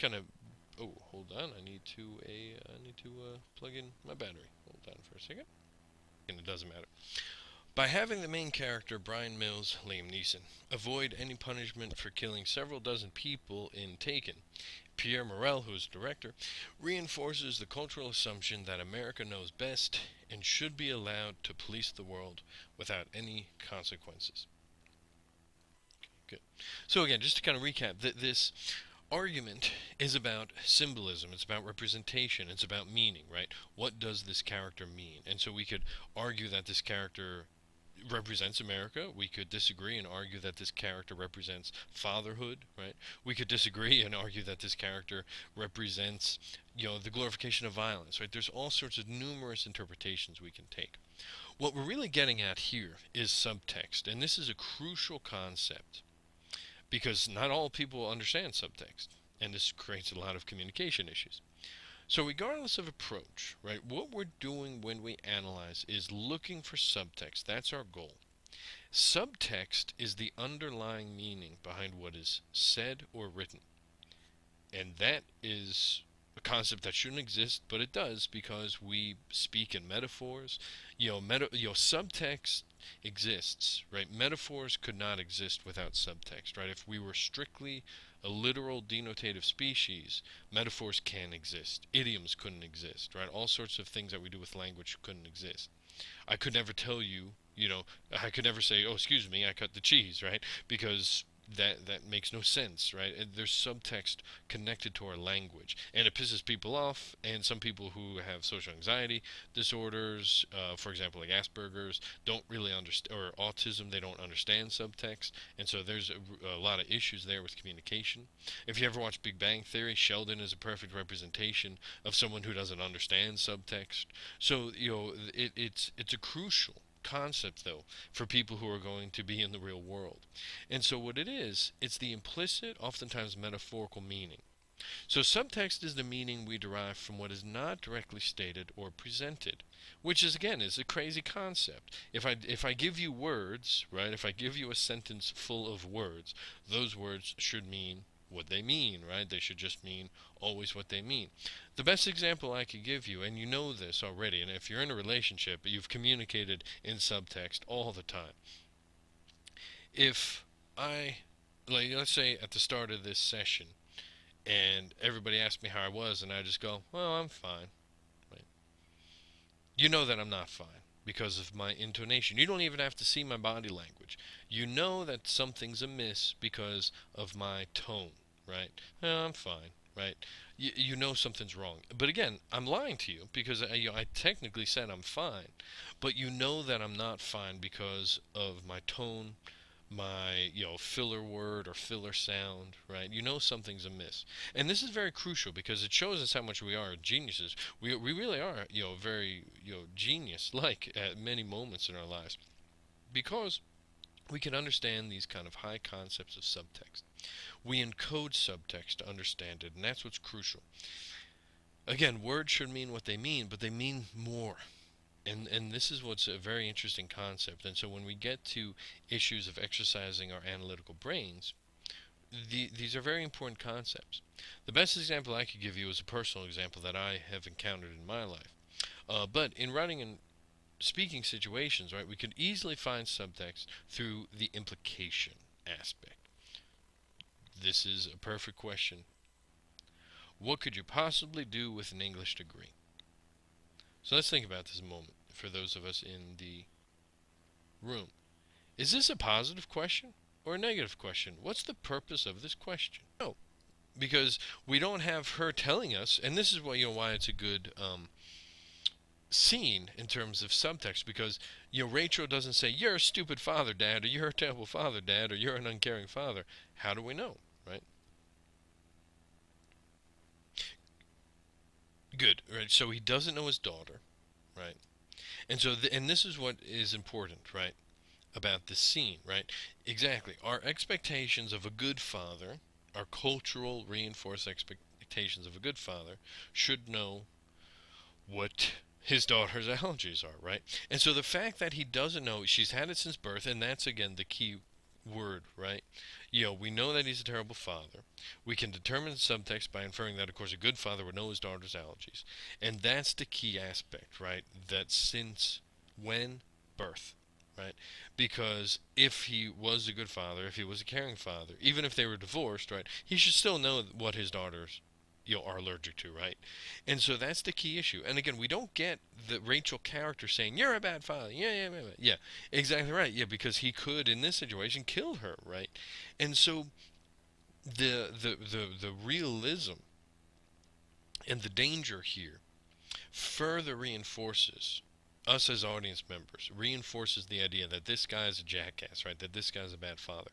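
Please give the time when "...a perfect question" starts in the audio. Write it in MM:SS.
03:58.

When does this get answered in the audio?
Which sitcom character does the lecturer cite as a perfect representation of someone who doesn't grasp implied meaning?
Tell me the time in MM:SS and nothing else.
01:59.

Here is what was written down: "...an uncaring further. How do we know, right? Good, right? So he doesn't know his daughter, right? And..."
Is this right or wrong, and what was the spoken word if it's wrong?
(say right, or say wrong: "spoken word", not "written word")
wrong: "father", not "further".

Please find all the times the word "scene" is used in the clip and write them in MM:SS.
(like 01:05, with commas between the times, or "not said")
04:19, 04:38.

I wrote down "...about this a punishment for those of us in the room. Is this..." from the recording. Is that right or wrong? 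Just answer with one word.
wrong.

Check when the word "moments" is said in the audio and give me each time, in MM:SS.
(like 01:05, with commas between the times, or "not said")
03:21, 04:04.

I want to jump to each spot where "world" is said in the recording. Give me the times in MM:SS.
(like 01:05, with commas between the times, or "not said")
00:22, 02:09.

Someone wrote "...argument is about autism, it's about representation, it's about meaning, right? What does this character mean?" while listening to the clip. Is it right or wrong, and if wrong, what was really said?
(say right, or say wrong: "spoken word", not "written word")
wrong: "symbolism", not "autism".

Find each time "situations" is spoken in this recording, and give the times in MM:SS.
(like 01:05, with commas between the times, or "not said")
03:51, 05:24.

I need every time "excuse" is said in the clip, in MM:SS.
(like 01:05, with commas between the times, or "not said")
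01:38.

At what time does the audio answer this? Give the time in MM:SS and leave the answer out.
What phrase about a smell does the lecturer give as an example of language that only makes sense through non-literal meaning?
01:39.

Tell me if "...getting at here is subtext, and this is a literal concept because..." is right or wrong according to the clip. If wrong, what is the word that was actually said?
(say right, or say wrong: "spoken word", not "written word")
wrong: "crucial", not "literal".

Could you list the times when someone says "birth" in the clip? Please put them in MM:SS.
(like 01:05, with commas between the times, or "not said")
04:53, 05:06.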